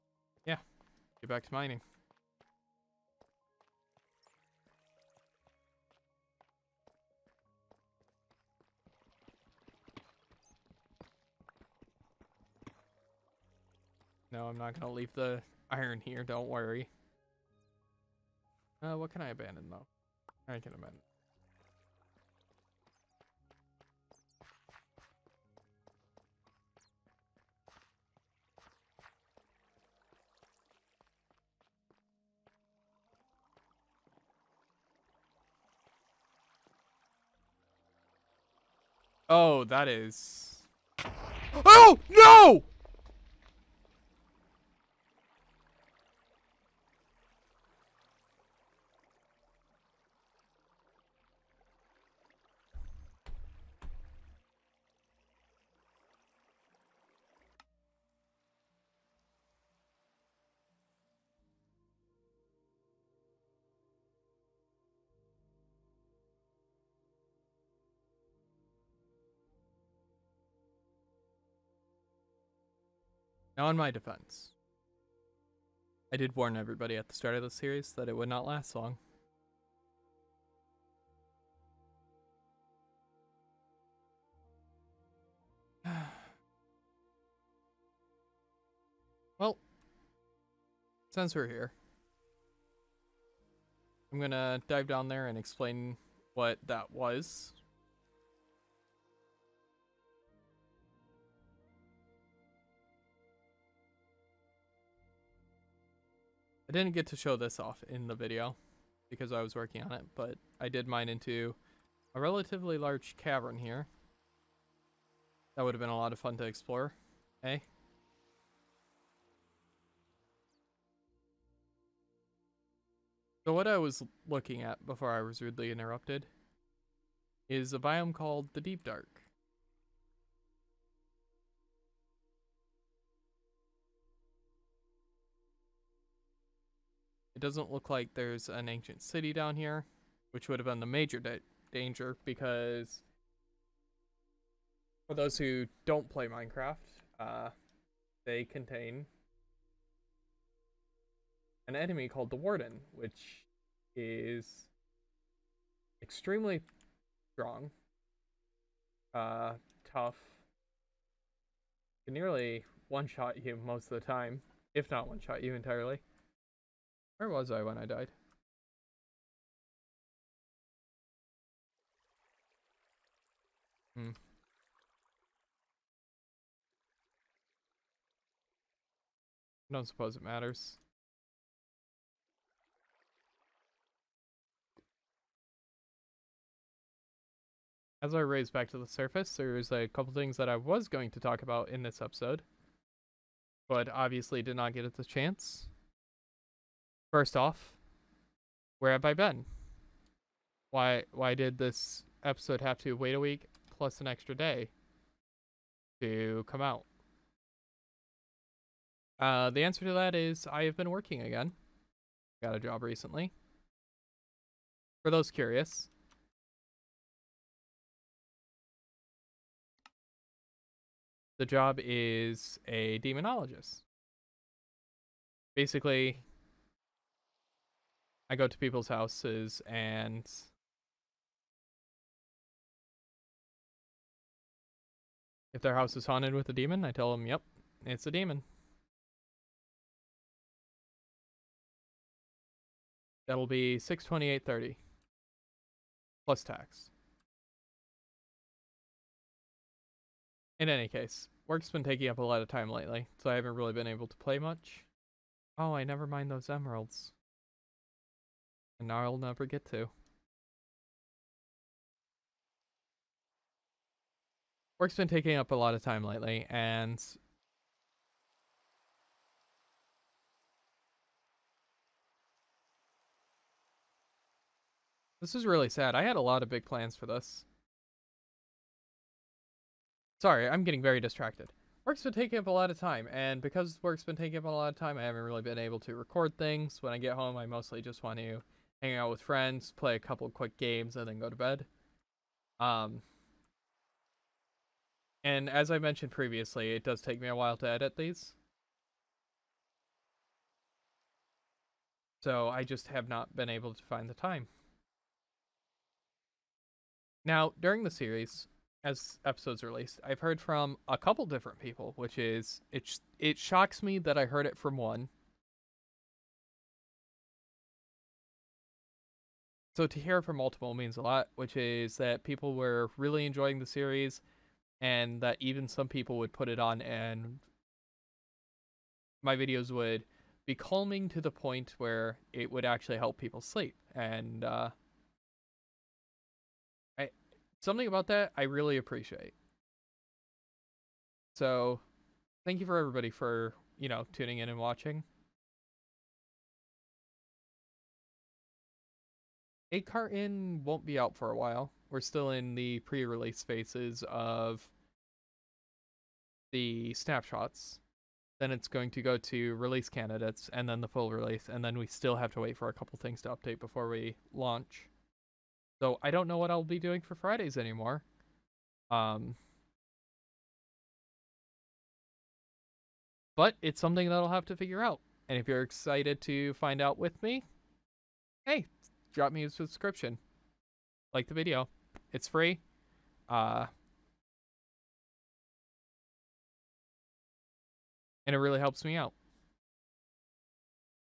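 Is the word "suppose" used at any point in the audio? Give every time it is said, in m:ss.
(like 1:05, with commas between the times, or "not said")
2:59.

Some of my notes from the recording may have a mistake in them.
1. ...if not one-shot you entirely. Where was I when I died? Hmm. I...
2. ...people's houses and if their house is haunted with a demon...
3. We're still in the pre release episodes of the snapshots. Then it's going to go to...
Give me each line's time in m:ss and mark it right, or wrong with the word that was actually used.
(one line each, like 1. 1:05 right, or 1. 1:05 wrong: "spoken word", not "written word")
1. 2:44 right
2. 3:48 right
3. 5:51 wrong: "phases", not "episodes".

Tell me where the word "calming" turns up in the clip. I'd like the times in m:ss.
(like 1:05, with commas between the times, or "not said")
5:30.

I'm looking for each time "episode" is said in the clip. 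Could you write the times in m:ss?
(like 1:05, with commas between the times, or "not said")
3:12, 3:22, 5:09.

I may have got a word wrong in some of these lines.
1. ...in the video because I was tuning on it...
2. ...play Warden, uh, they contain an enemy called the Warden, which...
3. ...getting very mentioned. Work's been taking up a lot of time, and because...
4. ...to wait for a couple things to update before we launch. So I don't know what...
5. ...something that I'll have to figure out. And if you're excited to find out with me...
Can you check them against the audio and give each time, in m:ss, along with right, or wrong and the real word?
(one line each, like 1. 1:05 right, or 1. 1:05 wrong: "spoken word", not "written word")
1. 1:47 wrong: "working", not "tuning"
2. 2:26 wrong: "Minecraft", not "Warden"
3. 4:40 wrong: "distracted", not "mentioned"
4. 6:02 right
5. 6:13 right.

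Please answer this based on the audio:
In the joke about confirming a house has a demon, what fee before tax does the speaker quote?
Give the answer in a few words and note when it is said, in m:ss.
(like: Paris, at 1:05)
628.30, at 4:03.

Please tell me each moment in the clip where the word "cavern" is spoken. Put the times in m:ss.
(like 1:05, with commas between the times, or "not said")
1:53.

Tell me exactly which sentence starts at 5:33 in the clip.
And uh, I something about that I really appreciate.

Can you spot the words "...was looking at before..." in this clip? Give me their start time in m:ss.
2:03.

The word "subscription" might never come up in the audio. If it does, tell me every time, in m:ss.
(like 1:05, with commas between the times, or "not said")
6:19.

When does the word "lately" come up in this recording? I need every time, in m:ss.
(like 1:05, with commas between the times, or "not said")
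4:12, 4:26.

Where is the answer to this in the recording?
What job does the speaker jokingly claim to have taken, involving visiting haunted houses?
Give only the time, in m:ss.
3:42.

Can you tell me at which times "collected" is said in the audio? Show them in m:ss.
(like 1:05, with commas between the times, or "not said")
not said.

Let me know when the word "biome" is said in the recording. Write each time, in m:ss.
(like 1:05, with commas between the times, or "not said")
2:07.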